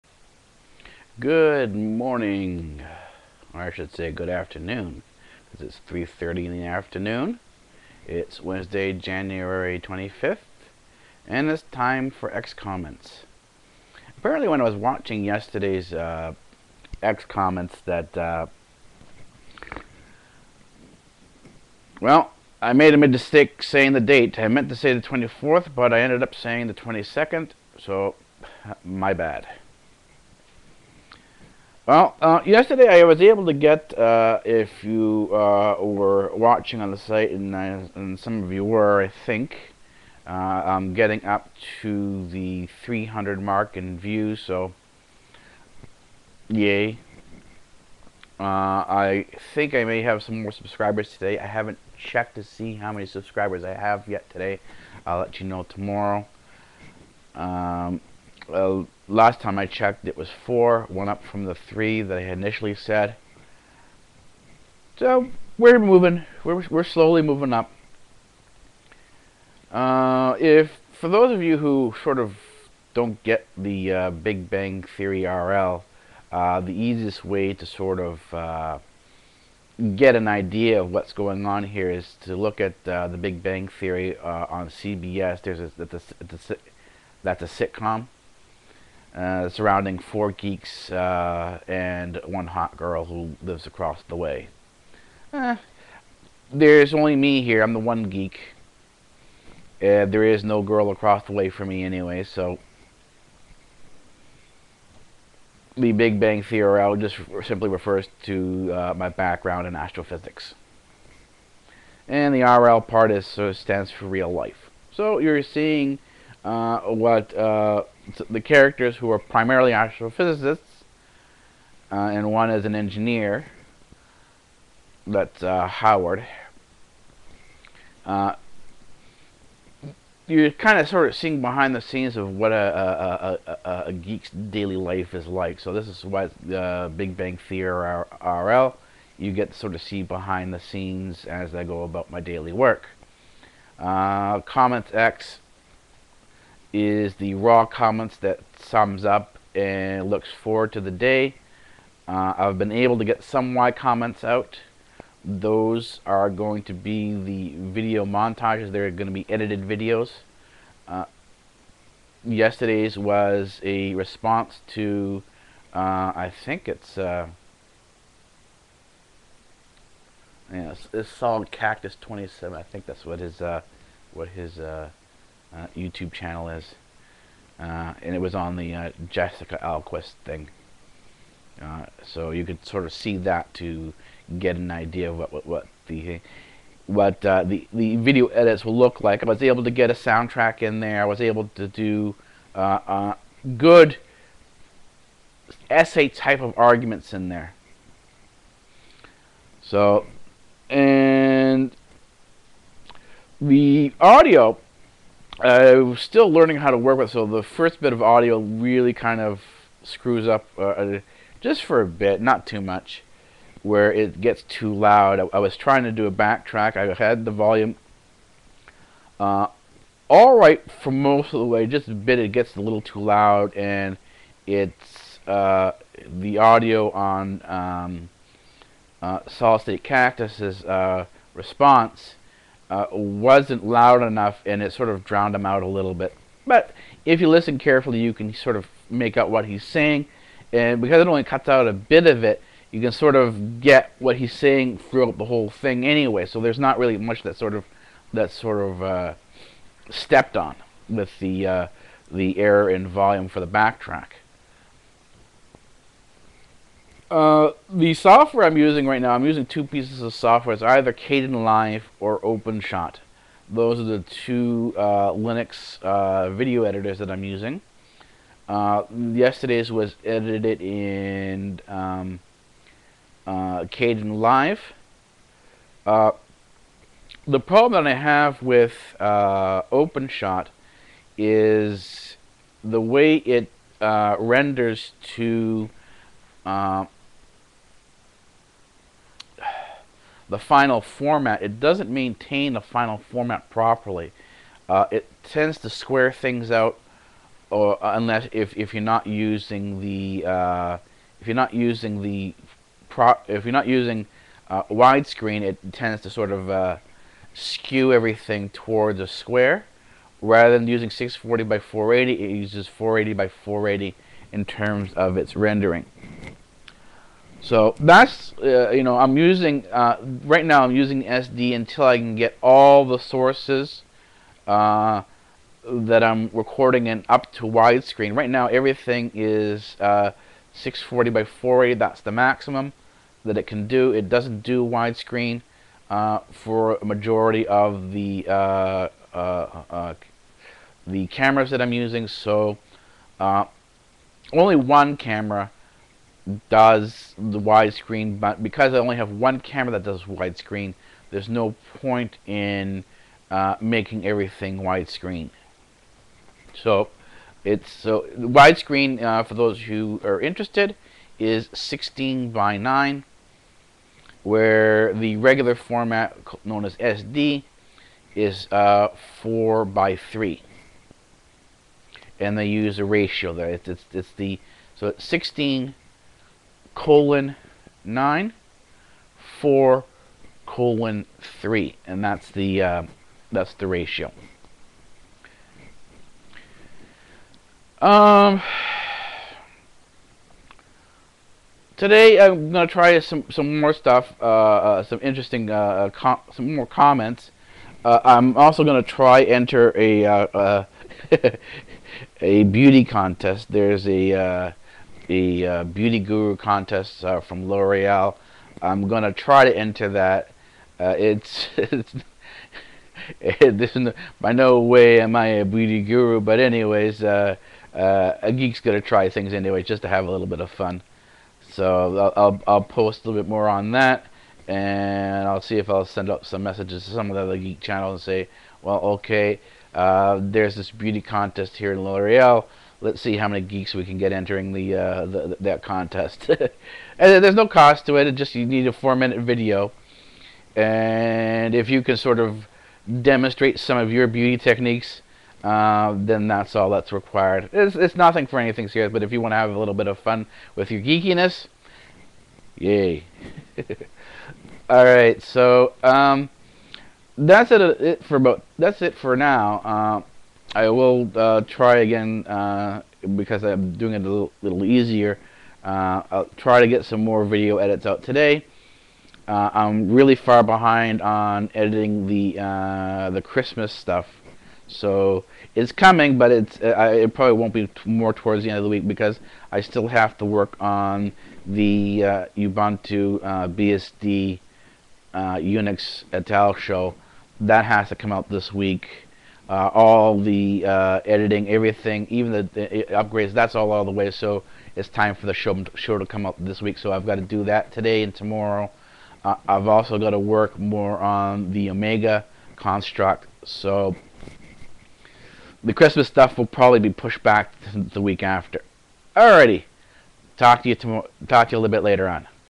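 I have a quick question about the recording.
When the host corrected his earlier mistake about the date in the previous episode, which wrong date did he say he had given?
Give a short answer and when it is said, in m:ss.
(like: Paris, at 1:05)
22nd, at 0:26.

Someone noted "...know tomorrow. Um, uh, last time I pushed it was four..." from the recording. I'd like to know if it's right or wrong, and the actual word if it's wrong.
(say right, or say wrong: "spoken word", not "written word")
wrong: "checked", not "pushed".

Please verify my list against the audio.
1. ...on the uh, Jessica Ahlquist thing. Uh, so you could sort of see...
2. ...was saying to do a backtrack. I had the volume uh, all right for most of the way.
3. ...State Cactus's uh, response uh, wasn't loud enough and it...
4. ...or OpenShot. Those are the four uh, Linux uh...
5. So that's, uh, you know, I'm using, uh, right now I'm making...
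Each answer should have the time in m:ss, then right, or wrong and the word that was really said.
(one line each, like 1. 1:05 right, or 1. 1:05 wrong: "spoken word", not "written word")
1. 2:58 right
2. 3:35 wrong: "trying", not "saying"
3. 3:49 right
4. 4:21 wrong: "two", not "four"
5. 5:17 wrong: "using", not "making".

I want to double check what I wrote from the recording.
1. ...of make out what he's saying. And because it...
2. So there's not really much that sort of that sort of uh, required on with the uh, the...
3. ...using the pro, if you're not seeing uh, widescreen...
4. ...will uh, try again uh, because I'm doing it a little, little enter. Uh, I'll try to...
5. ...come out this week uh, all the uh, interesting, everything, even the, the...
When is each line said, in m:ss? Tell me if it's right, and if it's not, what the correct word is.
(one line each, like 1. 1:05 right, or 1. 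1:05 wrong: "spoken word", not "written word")
1. 3:58 right
2. 4:06 wrong: "stepped", not "required"
3. 5:01 wrong: "using", not "seeing"
4. 7:40 wrong: "easier", not "enter"
5. 8:07 wrong: "editing", not "interesting".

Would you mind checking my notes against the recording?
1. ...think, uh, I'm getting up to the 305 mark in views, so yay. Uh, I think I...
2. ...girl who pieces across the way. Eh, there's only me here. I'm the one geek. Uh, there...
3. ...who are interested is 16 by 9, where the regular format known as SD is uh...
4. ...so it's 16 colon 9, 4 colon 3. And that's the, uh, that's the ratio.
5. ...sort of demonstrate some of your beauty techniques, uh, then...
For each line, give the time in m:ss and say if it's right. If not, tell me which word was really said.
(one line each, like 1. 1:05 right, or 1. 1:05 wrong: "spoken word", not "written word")
1. 0:39 wrong: "300", not "305"
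2. 1:32 wrong: "lives", not "pieces"
3. 5:59 right
4. 6:14 right
5. 7:21 right.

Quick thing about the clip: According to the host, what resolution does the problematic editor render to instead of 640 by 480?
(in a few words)
480 by 480.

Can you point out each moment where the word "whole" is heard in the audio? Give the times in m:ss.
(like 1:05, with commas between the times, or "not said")
4:05.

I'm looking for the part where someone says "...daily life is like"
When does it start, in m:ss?
2:14.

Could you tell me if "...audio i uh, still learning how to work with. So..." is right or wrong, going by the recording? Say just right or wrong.
right.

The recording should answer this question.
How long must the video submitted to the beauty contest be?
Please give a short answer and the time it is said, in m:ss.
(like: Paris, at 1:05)
4 minutes, at 7:18.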